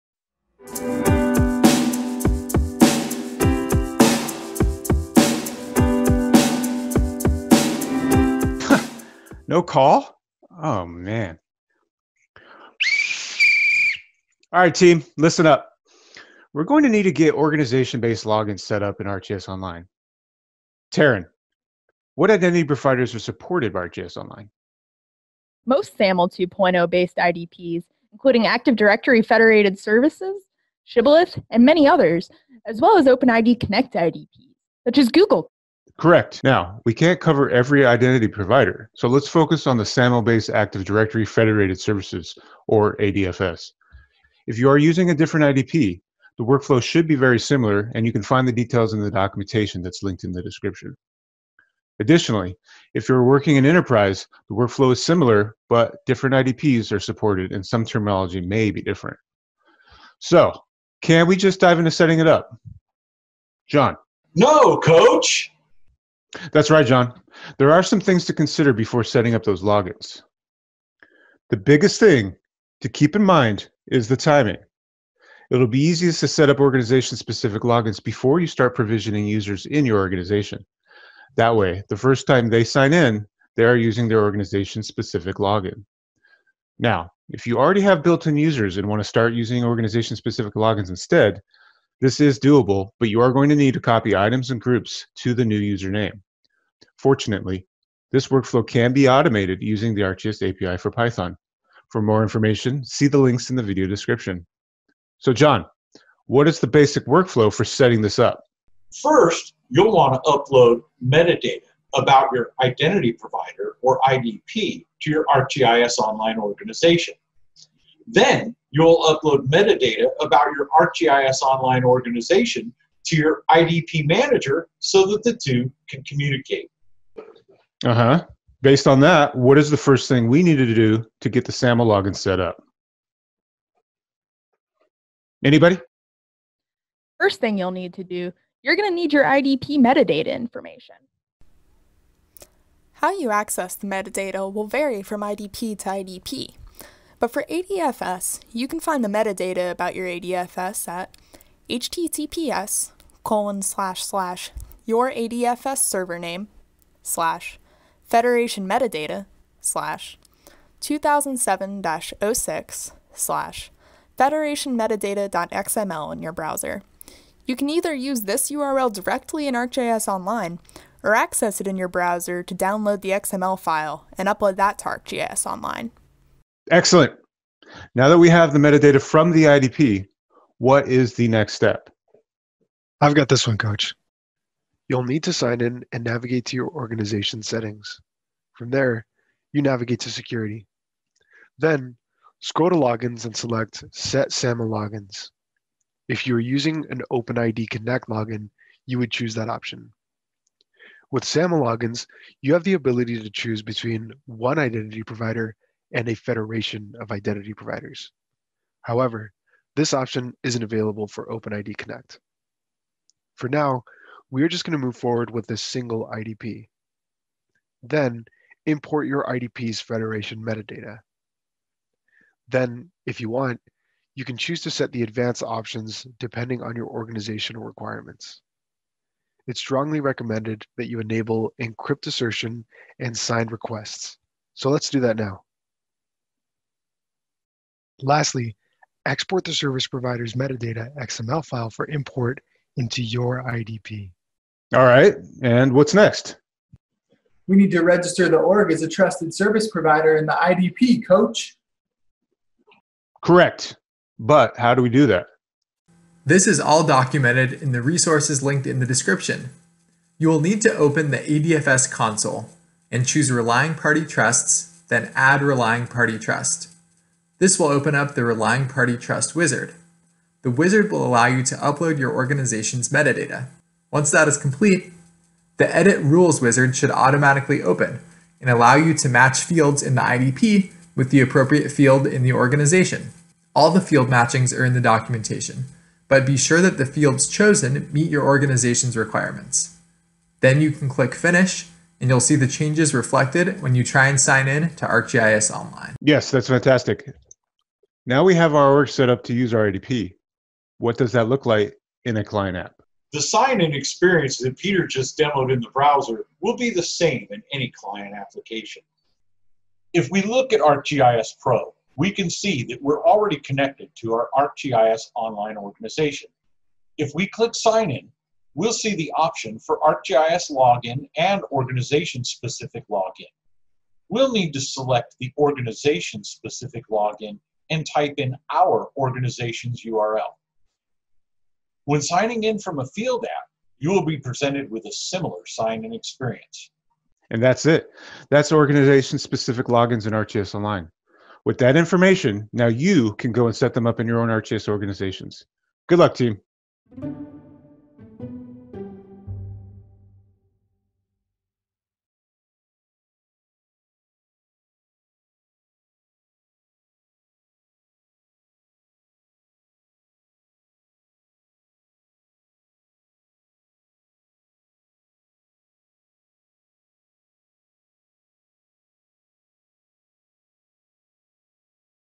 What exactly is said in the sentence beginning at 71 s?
The biggest thing to keep in mind is the timing.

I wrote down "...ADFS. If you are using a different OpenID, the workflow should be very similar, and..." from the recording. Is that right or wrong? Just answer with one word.
wrong.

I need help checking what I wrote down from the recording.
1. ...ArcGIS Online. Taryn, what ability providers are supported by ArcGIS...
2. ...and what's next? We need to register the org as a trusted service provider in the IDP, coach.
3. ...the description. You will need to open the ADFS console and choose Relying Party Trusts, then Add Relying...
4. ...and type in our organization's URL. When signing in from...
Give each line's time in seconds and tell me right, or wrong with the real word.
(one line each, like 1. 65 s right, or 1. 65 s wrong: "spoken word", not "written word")
1. 19 s wrong: "identity", not "ability"
2. 245 s right
3. 258 s right
4. 327 s right.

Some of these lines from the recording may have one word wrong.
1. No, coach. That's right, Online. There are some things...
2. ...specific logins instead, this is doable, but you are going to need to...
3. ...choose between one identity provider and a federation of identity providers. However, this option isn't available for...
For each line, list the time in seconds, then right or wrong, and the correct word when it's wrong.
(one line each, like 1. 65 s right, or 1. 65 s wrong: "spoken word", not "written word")
1. 64 s wrong: "John", not "Online"
2. 90 s right
3. 203 s right.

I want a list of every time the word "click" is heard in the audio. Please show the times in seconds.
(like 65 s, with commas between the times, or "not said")
290 s, 317 s.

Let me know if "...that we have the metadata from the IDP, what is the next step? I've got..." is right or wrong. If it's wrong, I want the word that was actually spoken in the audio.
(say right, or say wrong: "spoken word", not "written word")
right.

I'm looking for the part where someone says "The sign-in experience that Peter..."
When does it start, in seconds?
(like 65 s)
303 s.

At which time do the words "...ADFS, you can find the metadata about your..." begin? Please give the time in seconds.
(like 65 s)
147 s.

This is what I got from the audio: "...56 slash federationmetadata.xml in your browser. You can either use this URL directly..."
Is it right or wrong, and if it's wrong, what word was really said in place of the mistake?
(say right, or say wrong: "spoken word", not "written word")
wrong: "06", not "56".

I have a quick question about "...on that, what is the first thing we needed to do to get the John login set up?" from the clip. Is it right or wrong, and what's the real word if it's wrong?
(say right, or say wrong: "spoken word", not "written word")
wrong: "SAML", not "John".